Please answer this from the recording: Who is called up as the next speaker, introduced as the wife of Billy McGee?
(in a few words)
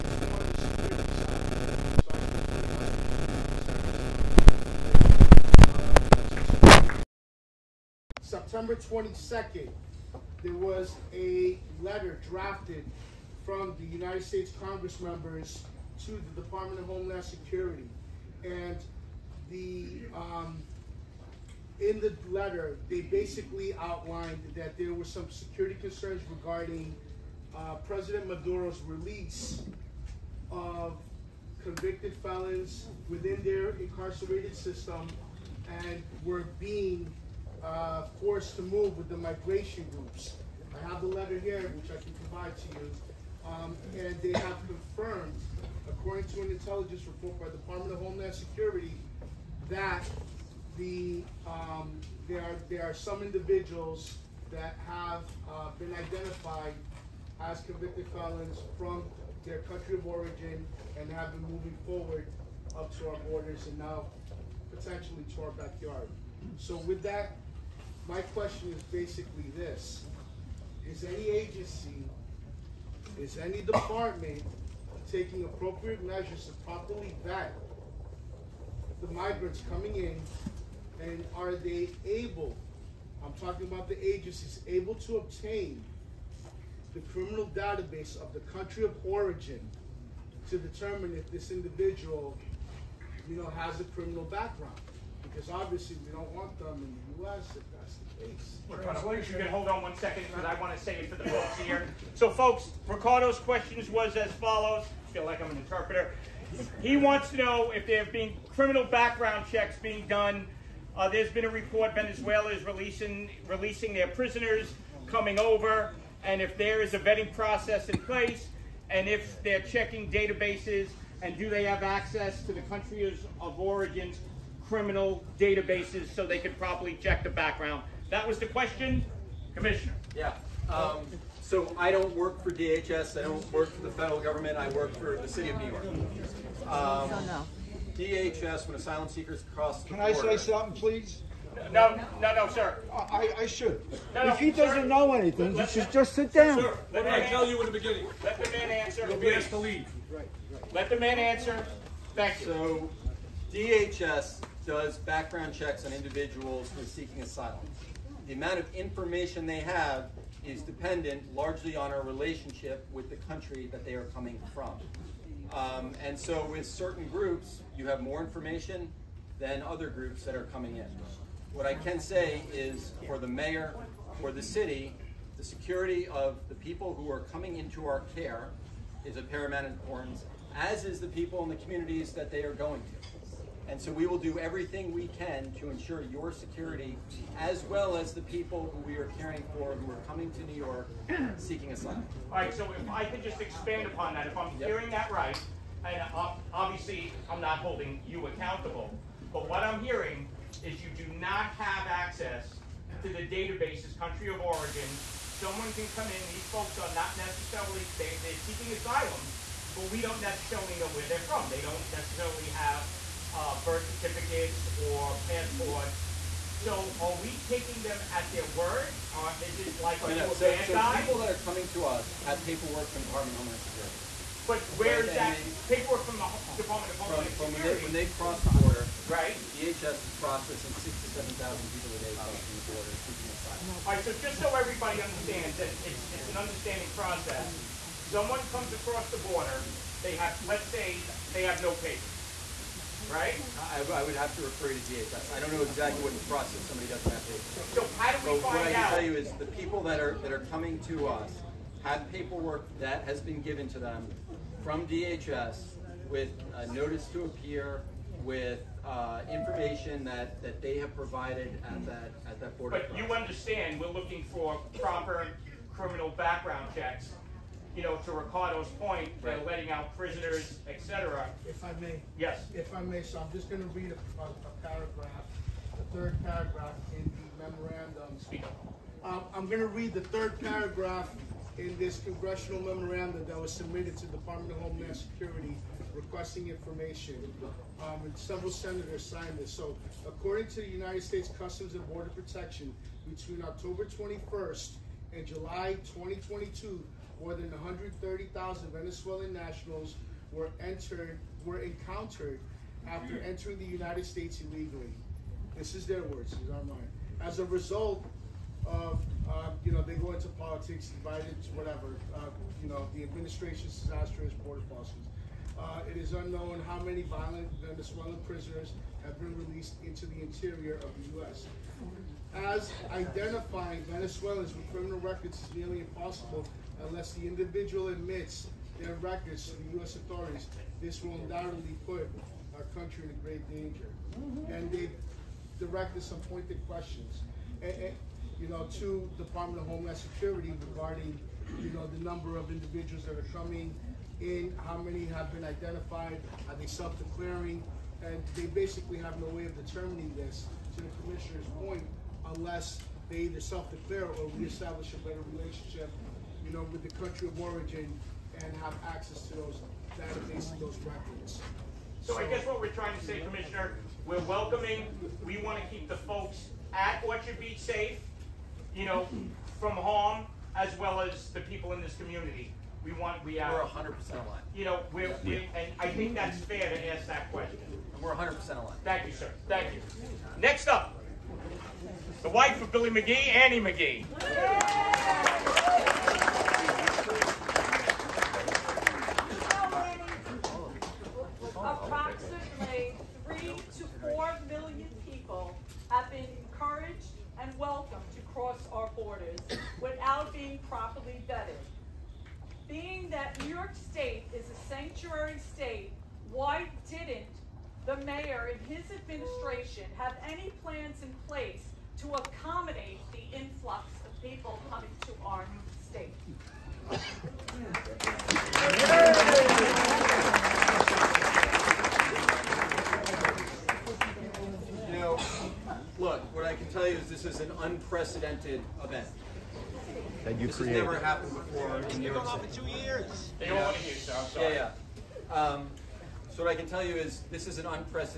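Annie McGee.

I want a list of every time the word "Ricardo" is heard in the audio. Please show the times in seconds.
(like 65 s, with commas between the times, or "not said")
102 s, 268 s.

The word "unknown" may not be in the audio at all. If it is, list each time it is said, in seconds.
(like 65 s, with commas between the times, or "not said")
316 s.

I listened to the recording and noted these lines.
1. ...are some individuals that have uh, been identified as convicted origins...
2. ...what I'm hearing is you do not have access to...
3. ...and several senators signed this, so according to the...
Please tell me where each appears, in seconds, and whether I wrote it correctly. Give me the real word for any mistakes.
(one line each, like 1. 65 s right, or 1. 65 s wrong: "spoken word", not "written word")
1. 52 s wrong: "felons", not "origins"
2. 199 s right
3. 288 s right.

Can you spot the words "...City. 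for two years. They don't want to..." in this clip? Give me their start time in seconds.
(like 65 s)
432 s.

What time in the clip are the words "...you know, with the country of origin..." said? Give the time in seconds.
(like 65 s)
356 s.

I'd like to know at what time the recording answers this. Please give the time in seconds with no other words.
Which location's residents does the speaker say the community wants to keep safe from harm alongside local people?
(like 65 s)
367 s.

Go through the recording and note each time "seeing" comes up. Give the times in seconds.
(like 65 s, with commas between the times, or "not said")
not said.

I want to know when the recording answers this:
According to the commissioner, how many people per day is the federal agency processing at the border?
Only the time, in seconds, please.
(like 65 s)
230 s.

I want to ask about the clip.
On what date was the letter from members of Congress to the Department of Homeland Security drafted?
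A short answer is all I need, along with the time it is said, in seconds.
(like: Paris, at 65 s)
September 22nd, at 8 s.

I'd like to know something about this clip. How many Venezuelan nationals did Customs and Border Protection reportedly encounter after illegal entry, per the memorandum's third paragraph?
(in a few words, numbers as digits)
130,000.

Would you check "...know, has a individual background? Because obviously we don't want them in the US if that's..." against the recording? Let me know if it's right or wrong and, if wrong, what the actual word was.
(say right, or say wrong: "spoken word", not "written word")
wrong: "criminal", not "individual".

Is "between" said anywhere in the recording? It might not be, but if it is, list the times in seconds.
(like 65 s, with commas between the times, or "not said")
293 s.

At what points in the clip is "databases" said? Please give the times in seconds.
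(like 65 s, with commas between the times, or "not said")
87 s, 120 s, 125 s, 203 s, 359 s.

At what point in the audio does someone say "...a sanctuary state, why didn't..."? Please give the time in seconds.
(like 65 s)
404 s.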